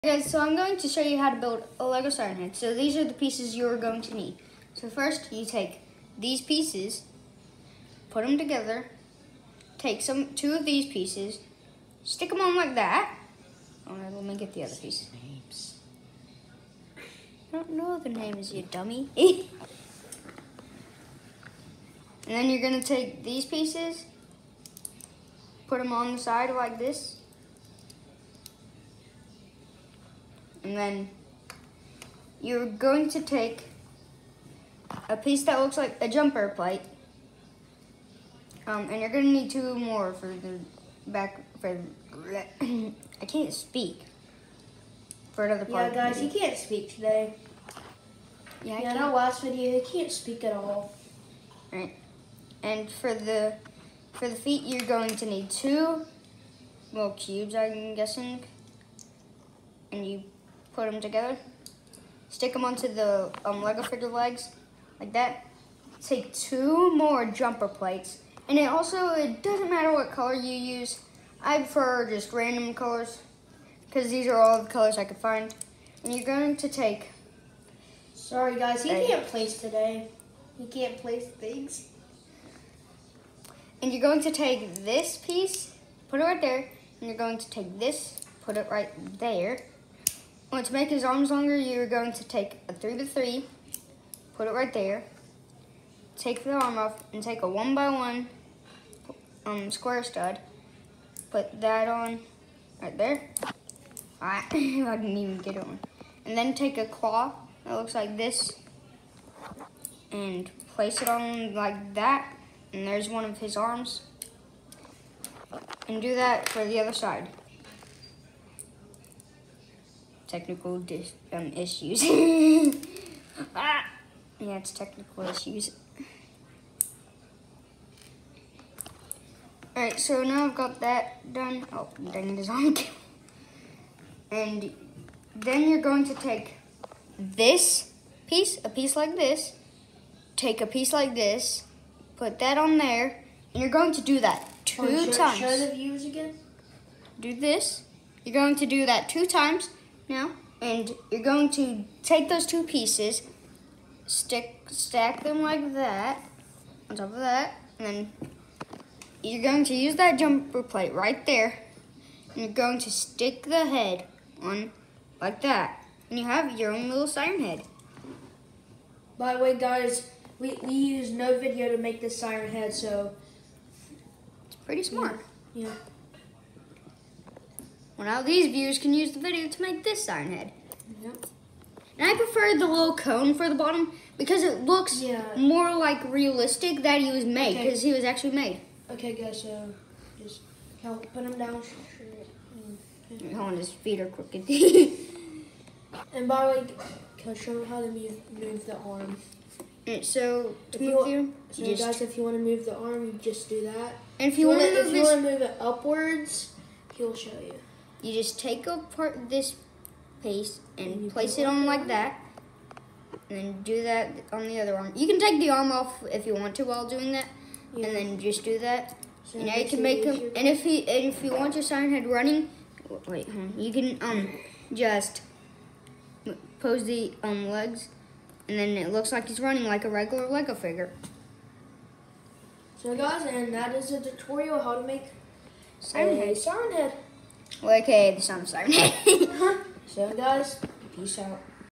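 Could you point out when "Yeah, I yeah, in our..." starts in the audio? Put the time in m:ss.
0:48.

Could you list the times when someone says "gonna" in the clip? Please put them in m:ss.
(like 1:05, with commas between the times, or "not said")
0:22, 0:39.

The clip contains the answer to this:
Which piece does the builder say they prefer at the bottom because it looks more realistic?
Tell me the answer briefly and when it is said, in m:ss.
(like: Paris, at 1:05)
little cone, at 3:02.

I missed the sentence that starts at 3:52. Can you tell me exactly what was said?
So guys, and that is a tutorial how to make sign Head.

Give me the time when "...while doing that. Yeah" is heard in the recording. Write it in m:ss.
3:36.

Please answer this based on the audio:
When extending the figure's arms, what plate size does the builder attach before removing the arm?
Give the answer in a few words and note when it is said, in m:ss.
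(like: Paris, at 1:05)
3 by 3, at 1:32.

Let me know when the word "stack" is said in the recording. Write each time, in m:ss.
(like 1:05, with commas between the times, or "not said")
2:34.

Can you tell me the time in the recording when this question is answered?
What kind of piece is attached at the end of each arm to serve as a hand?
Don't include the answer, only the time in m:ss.
1:46.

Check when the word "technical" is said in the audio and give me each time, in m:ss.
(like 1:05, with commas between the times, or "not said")
2:00, 2:04.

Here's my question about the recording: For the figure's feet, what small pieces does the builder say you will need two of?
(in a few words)
little cubes.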